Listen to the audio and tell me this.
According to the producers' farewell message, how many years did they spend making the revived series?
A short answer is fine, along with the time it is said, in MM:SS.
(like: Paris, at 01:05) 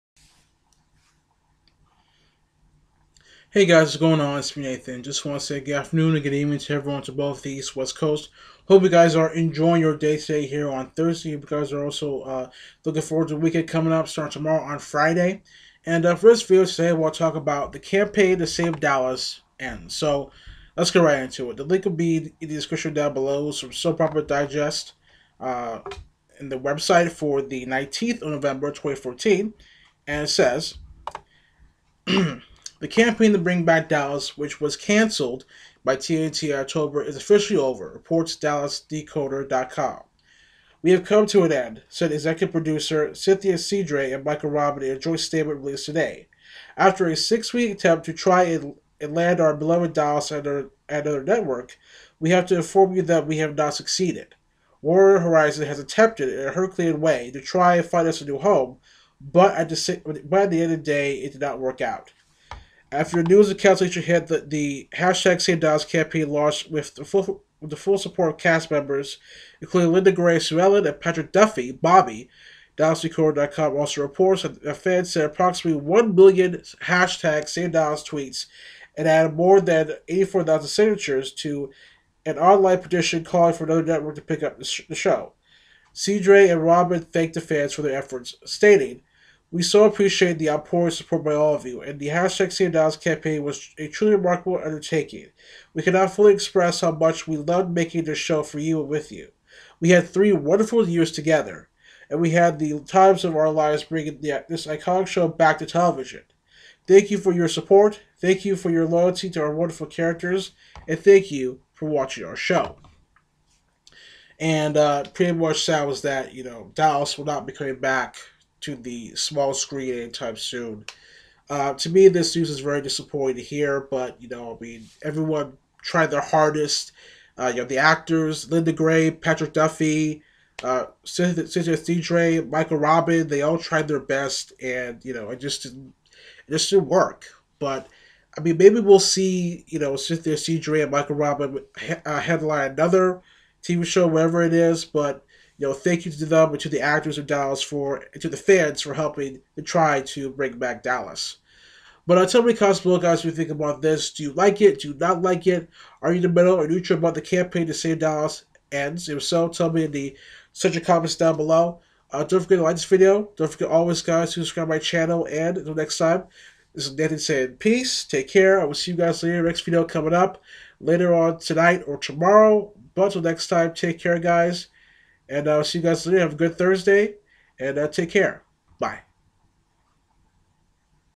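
3, at 01:40.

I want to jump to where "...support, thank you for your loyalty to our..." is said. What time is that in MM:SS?
01:47.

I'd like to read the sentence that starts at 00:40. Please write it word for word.
We have come to an end, said executive producer Cynthia Cidre and Michael Robin in a joint statement released today.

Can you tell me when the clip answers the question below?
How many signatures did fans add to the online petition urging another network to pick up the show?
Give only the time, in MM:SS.
01:20.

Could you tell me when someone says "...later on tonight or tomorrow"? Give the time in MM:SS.
02:50.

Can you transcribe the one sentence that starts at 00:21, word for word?
The link will be in the description down below.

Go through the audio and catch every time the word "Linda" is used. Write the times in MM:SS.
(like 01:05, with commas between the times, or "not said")
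01:09, 02:08.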